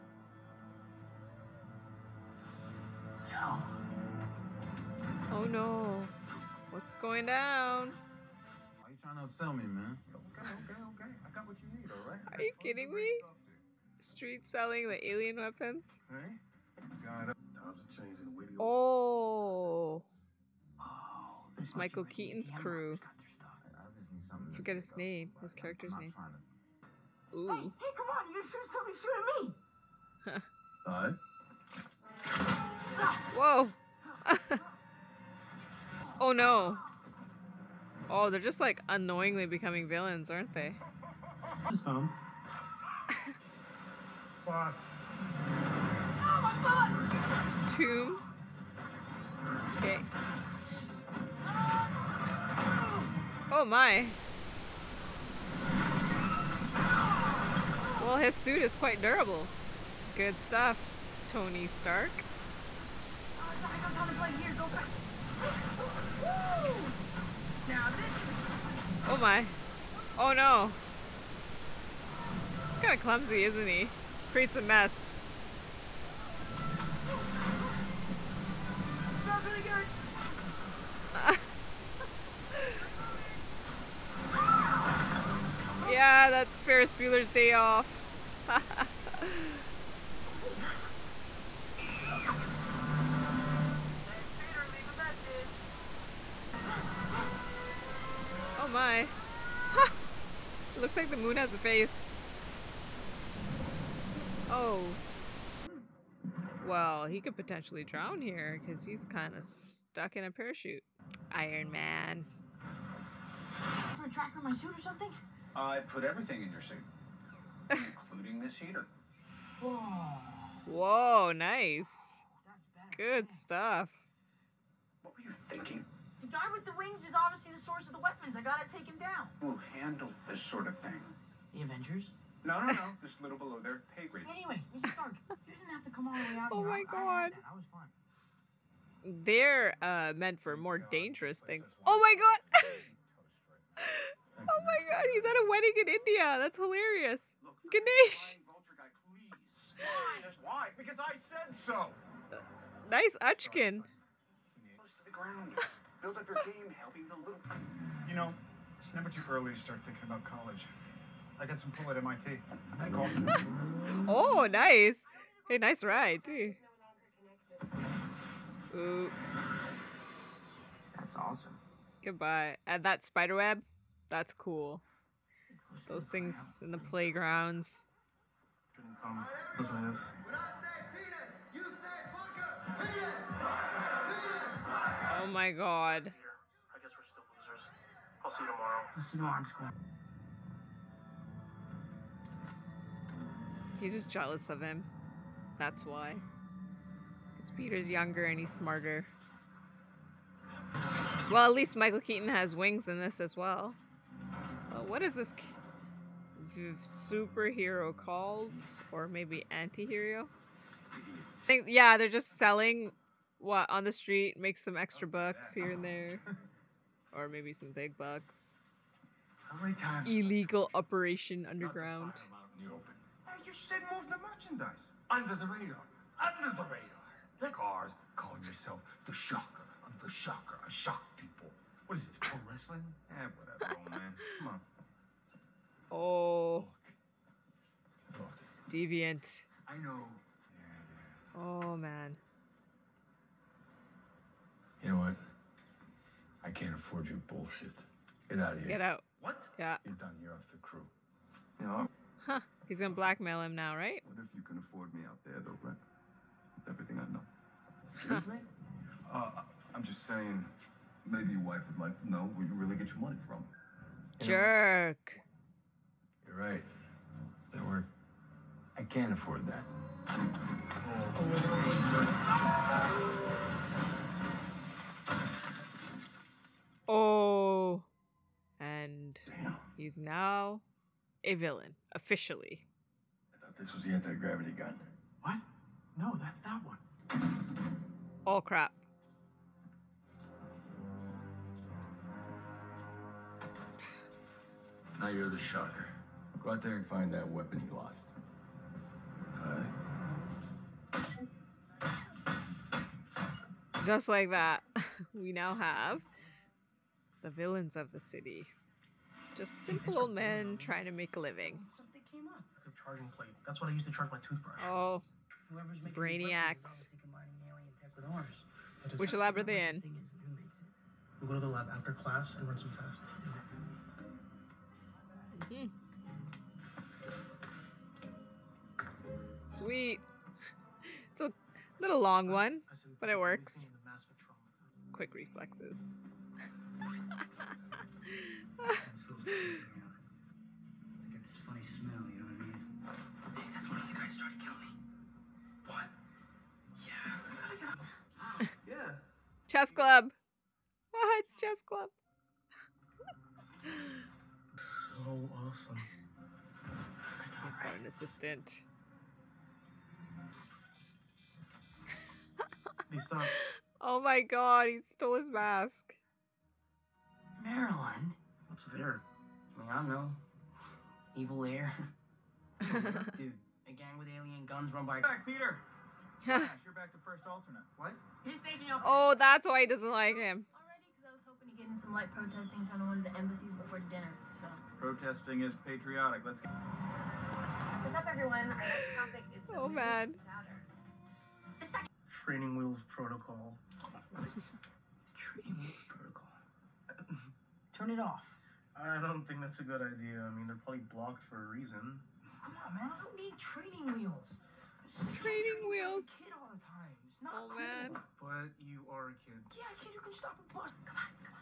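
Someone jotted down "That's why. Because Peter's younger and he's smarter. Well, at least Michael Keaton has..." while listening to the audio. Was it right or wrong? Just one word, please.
right.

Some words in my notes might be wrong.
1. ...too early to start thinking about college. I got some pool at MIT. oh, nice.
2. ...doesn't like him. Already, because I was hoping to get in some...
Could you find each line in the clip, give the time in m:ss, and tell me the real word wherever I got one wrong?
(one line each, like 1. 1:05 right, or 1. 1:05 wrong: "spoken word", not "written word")
1. 2:39 right
2. 6:19 right.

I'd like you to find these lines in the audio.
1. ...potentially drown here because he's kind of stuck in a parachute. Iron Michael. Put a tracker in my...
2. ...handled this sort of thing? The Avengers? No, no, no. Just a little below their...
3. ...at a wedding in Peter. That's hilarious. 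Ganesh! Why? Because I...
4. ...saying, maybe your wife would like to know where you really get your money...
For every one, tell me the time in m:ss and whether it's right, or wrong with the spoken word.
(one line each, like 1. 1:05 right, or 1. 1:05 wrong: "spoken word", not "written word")
1. 1:47 wrong: "Man", not "Michael"
2. 2:09 right
3. 2:25 wrong: "India", not "Peter"
4. 4:20 right.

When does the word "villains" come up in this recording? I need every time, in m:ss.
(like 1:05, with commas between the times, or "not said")
0:39, 4:41, 5:07.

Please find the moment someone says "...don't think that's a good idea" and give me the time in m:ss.
6:39.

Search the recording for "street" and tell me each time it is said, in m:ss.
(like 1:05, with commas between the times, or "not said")
0:13, 3:33.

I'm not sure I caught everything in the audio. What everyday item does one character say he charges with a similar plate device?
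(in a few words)
Toothbrush.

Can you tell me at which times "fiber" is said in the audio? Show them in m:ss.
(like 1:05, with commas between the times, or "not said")
not said.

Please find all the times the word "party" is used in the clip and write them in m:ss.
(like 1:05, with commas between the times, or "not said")
not said.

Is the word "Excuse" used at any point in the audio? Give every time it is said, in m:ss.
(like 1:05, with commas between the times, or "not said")
4:17.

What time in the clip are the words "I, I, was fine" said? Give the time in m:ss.
2:17.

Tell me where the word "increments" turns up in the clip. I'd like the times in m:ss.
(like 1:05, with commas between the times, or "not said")
not said.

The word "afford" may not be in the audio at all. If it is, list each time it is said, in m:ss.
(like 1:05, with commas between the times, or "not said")
4:06, 4:14, 4:29.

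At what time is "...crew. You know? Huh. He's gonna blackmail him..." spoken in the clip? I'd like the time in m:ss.
4:10.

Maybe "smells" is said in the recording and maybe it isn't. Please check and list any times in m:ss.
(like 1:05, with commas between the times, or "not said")
1:19, 5:41.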